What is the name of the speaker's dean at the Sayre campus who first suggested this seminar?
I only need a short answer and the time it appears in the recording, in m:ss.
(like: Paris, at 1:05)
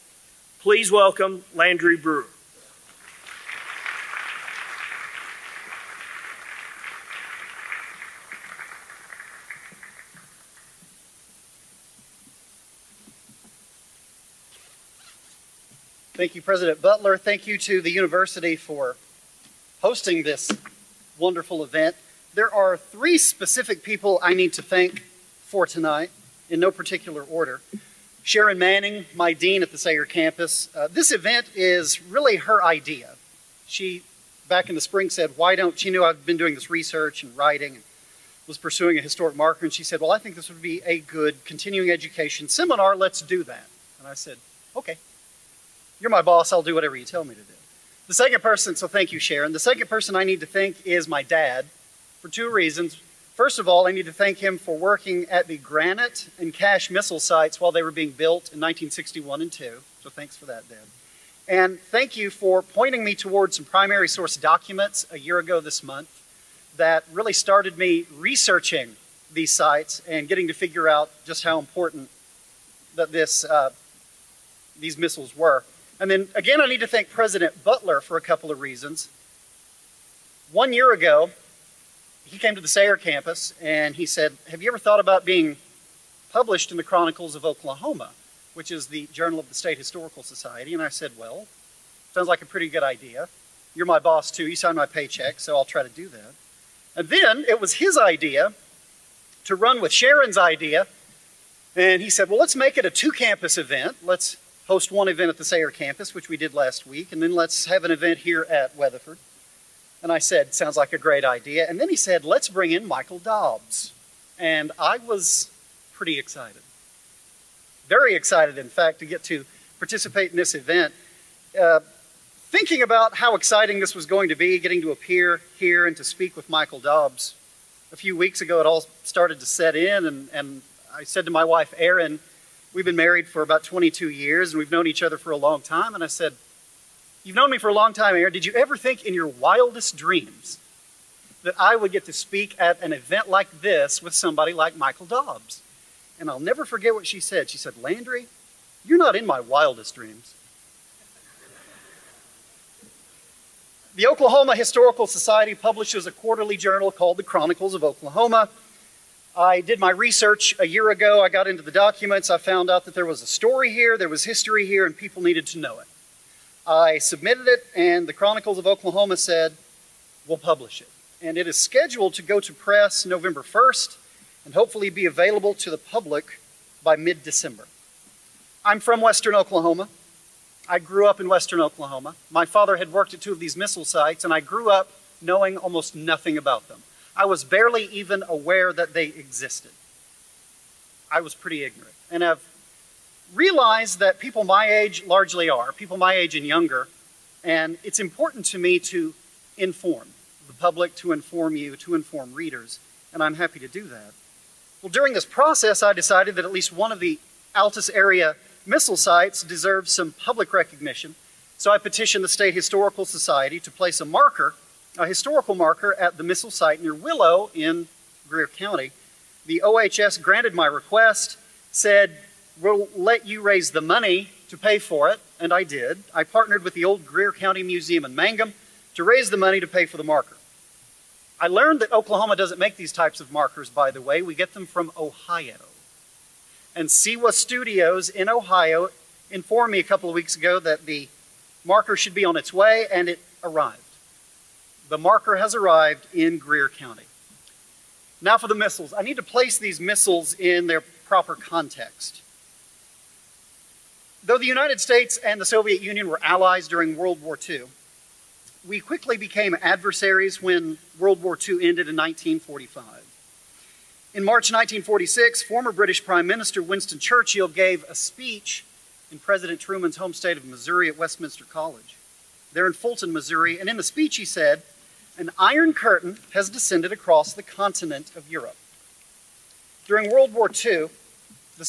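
Sharon Manning, at 0:28.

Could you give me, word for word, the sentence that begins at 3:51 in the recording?
I learned that Oklahoma doesn't make these types of markers, by the way.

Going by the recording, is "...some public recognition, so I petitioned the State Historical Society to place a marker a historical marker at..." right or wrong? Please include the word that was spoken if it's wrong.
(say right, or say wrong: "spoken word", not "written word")
right.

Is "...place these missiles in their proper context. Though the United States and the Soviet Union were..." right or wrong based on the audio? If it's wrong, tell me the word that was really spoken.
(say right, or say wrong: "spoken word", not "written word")
right.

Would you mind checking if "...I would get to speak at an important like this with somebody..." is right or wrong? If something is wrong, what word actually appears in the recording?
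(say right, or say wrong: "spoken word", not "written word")
wrong: "event", not "important".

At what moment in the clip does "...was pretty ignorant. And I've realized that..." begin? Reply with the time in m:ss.
3:11.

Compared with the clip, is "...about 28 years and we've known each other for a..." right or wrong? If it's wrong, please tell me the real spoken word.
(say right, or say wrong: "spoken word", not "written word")
wrong: "22", not "28".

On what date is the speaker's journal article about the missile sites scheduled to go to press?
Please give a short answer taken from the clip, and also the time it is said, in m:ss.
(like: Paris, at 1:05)
November 1, at 2:53.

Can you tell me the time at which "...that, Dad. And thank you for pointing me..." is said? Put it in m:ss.
1:00.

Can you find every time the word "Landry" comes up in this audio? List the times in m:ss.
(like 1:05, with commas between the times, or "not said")
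0:01, 2:27.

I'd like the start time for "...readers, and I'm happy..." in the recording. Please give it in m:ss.
3:22.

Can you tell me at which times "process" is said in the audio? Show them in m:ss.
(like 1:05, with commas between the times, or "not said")
3:25.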